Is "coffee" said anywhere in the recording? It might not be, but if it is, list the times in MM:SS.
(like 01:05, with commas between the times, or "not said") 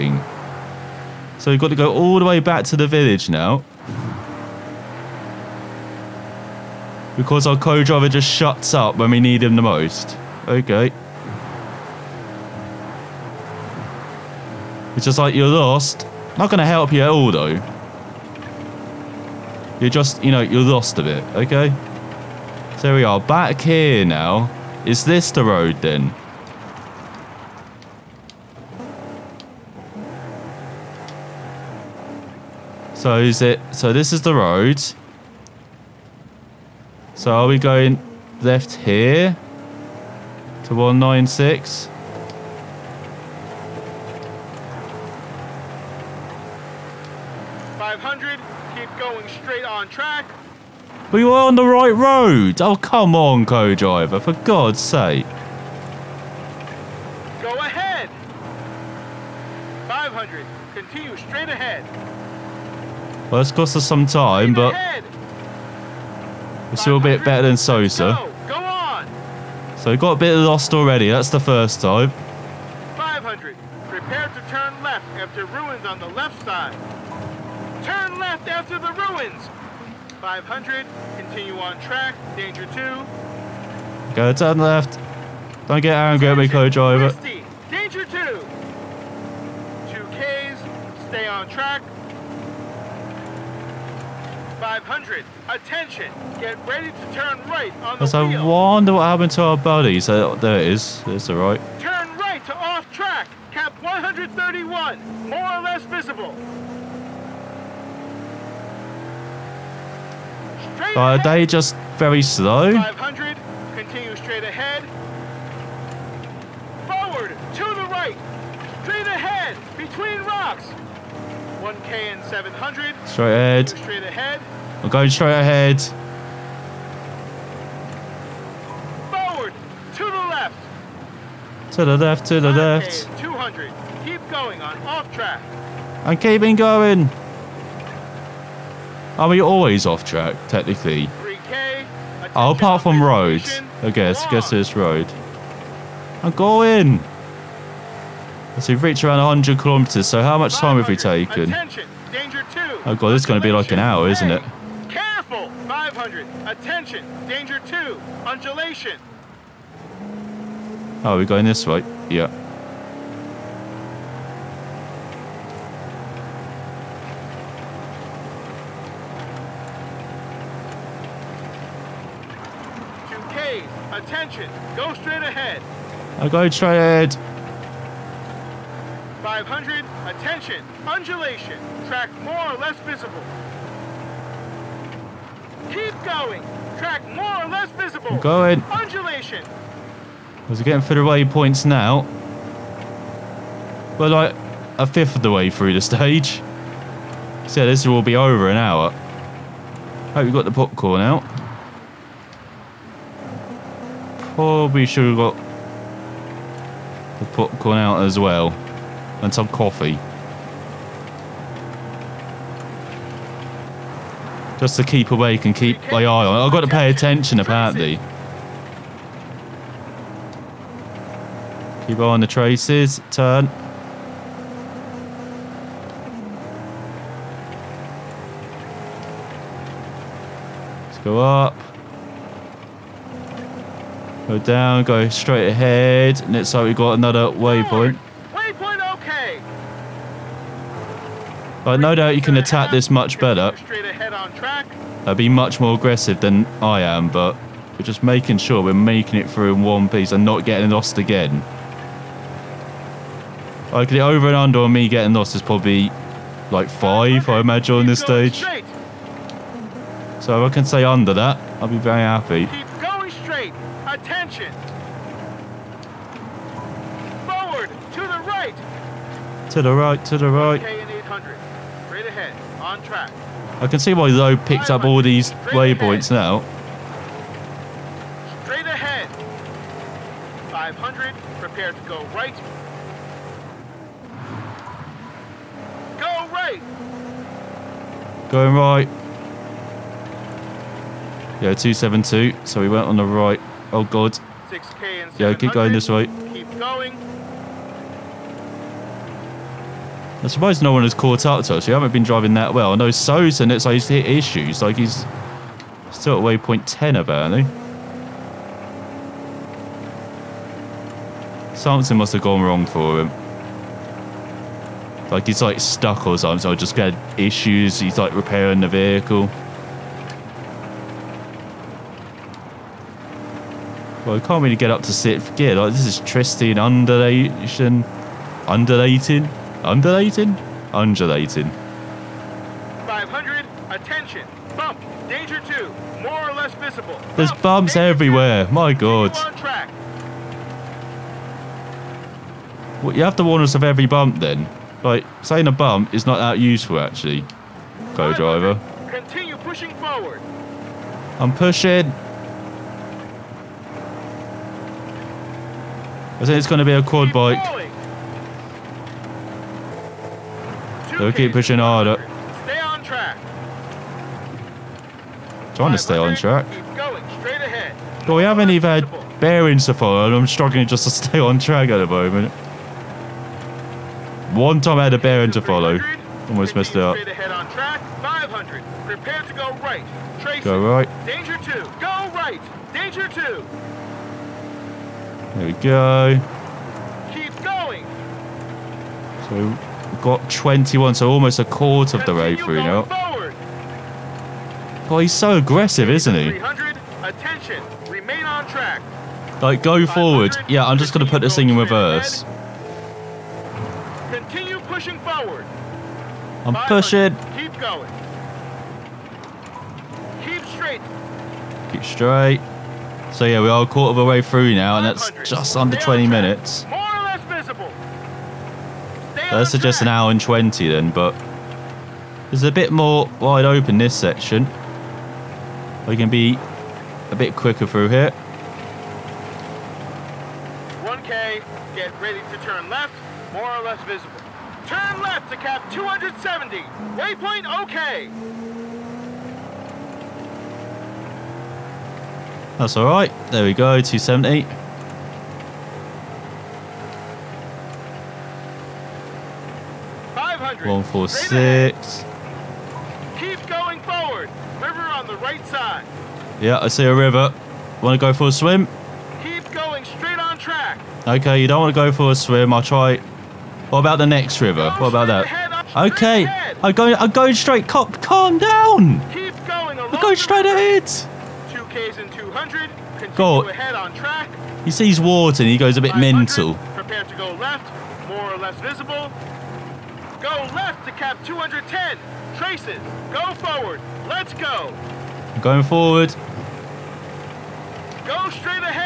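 03:29.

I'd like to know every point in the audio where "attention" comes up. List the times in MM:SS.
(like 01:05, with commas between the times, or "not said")
01:35, 02:36, 02:53, 03:00, 03:36, 04:23, 05:33.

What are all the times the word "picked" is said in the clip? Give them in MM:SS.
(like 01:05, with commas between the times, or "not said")
04:34.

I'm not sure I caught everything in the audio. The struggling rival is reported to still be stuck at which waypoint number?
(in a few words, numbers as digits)
10.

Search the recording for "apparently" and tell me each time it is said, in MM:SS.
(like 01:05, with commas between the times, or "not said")
03:37, 05:06.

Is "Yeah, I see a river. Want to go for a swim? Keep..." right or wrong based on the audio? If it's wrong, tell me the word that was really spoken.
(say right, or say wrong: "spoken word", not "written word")
right.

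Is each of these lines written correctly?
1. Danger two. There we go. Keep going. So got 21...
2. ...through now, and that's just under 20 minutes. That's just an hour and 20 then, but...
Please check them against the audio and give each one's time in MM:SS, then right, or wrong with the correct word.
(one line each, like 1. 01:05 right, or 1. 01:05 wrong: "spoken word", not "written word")
1. 06:22 right
2. 06:54 right.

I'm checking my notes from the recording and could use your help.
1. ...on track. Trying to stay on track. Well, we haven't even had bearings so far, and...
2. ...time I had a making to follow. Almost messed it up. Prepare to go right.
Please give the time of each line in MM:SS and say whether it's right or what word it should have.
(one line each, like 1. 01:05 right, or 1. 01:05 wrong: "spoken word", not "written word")
1. 06:02 right
2. 06:14 wrong: "bearing", not "making".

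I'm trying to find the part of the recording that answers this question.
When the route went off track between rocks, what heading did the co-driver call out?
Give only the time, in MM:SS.
01:43.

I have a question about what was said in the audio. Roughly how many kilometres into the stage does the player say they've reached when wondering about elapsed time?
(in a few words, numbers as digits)
100.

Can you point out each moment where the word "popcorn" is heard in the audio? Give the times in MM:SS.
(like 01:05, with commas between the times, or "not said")
03:20, 03:27.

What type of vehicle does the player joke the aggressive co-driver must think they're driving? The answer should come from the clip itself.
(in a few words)
quad bike.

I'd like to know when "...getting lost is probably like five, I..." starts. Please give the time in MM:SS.
04:14.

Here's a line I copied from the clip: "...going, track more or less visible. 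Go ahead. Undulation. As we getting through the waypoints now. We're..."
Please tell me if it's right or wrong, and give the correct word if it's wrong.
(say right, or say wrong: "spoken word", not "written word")
right.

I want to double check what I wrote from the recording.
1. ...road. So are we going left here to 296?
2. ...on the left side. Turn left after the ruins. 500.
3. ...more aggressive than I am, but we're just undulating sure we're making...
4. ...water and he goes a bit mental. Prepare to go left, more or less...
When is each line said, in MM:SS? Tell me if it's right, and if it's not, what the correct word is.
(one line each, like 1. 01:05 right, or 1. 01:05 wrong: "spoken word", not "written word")
1. 00:34 wrong: "196", not "296"
2. 01:15 right
3. 04:05 wrong: "making", not "undulating"
4. 07:55 right.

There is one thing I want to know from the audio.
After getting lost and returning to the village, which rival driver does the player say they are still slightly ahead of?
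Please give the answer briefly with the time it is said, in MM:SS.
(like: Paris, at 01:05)
Sosa, at 01:07.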